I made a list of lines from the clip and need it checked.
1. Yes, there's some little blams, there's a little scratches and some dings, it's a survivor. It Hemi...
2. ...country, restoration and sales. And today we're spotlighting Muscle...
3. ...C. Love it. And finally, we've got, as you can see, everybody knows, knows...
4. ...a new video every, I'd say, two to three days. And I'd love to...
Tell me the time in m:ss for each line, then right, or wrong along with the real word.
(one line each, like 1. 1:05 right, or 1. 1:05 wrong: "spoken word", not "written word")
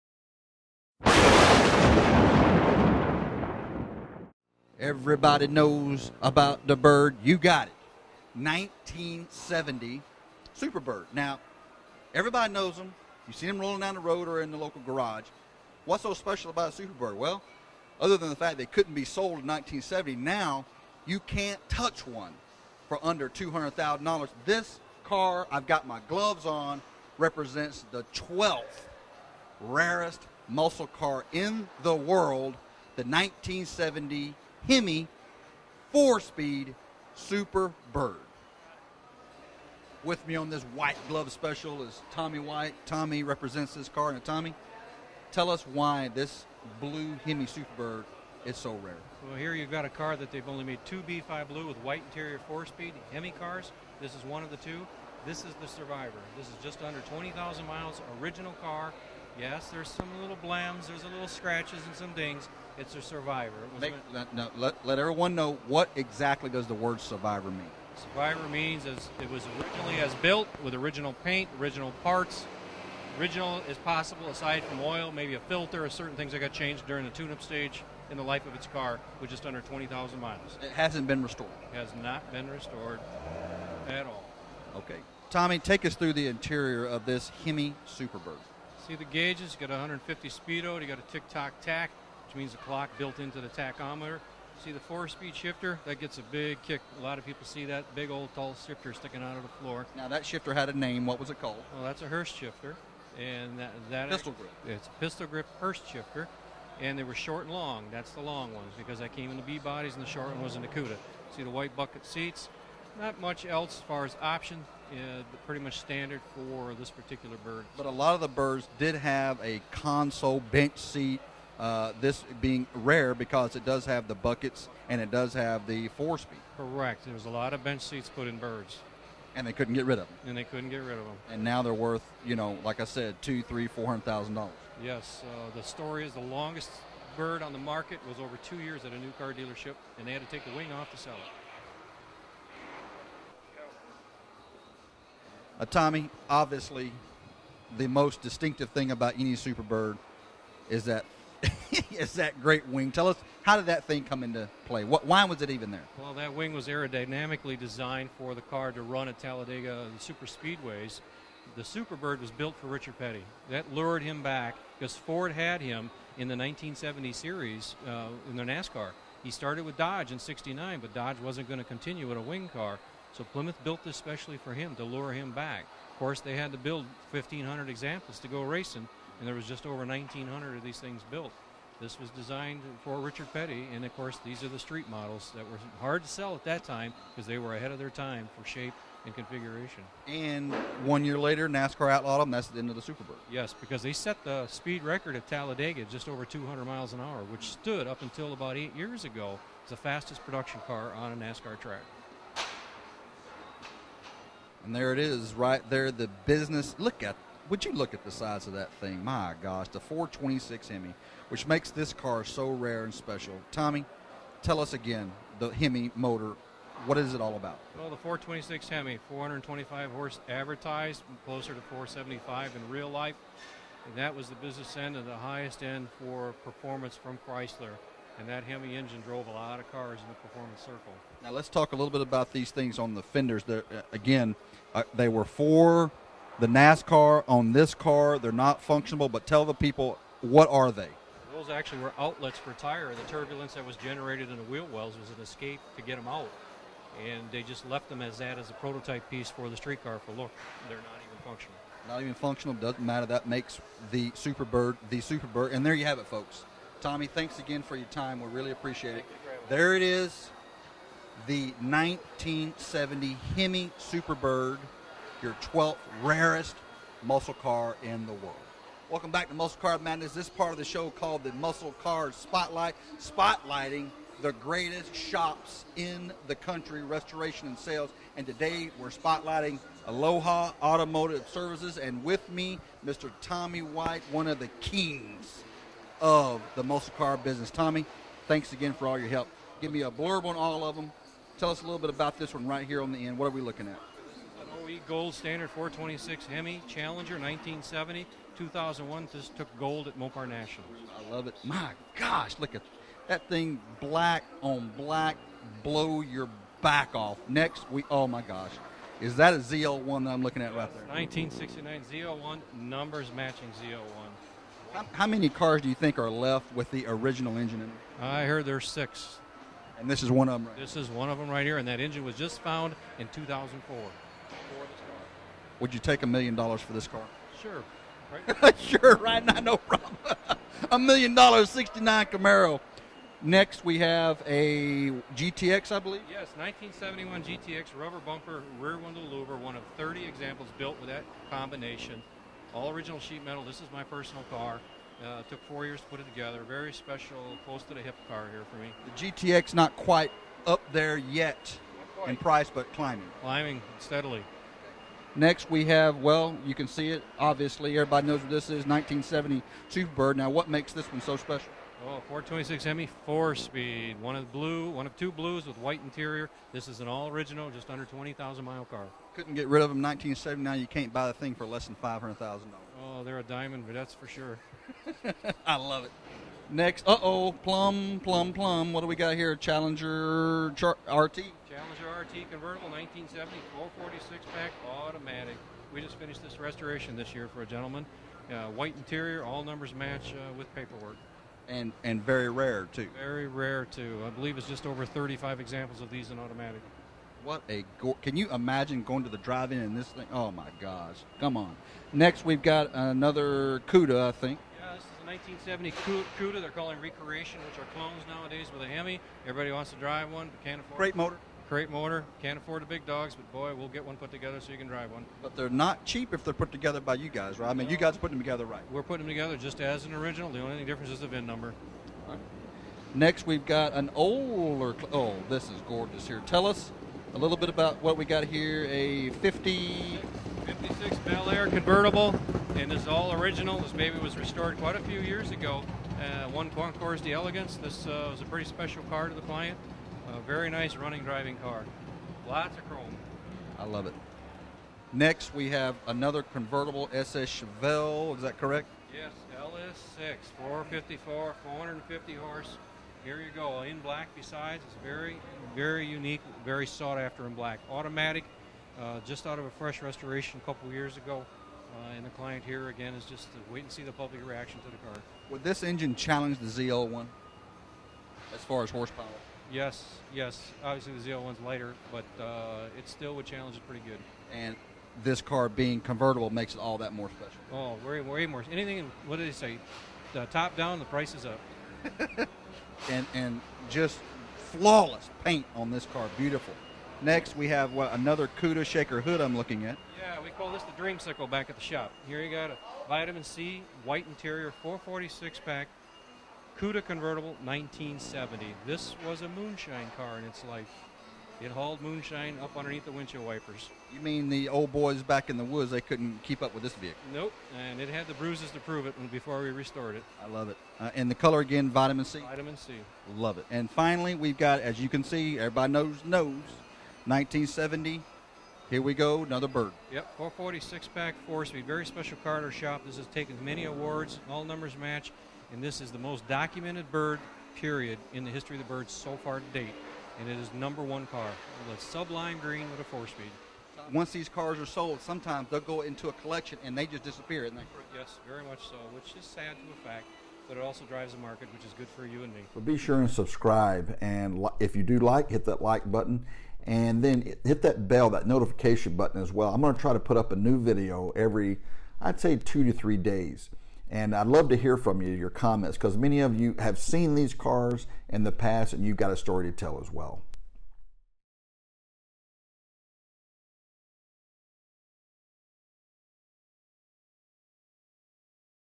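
1. 0:59 wrong: "Make", not "Hemi"
2. 4:36 wrong: "Aloha", not "Muscle"
3. 8:32 right
4. 9:10 right.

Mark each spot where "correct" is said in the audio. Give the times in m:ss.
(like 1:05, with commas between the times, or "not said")
2:06, 7:28.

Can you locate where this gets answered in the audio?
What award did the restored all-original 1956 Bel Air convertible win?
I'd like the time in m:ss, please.
7:16.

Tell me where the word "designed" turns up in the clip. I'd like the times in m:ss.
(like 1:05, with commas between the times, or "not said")
2:37, 3:02.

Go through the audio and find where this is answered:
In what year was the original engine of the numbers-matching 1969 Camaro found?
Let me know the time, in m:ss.
5:23.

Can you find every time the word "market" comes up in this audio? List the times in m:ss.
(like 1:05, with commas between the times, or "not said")
2:17, 9:01.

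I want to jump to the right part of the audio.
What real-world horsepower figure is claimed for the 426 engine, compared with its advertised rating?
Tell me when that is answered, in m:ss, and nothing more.
3:41.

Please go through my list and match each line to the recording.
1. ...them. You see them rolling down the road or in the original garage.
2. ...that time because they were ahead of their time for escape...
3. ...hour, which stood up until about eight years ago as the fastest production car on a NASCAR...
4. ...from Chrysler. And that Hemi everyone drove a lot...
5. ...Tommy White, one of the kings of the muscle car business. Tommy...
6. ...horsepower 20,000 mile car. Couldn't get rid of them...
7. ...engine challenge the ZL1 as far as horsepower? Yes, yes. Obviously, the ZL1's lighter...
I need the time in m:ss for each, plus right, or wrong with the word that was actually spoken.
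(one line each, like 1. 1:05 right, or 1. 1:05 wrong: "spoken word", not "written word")
1. 0:12 wrong: "local", not "original"
2. 3:06 wrong: "shape", not "escape"
3. 3:17 right
4. 3:46 wrong: "engine", not "everyone"
5. 4:43 right
6. 6:07 wrong: "under", not "horsepower"
7. 7:45 right.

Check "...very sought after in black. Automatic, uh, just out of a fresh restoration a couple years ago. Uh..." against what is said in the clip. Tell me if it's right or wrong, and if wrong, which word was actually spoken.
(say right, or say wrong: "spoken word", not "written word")
right.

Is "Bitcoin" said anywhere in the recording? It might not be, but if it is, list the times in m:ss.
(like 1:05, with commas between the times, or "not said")
not said.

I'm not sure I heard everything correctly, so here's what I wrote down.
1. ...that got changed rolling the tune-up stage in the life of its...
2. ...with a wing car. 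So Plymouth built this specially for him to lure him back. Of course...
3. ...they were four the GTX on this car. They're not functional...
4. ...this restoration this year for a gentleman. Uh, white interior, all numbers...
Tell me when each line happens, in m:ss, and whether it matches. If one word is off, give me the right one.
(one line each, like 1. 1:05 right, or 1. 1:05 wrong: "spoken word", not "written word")
1. 1:16 wrong: "during", not "rolling"
2. 2:52 right
3. 3:54 wrong: "NASCAR", not "GTX"
4. 6:26 right.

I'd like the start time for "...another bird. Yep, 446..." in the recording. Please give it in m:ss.
8:39.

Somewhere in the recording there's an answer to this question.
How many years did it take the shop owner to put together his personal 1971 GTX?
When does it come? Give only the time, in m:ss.
5:45.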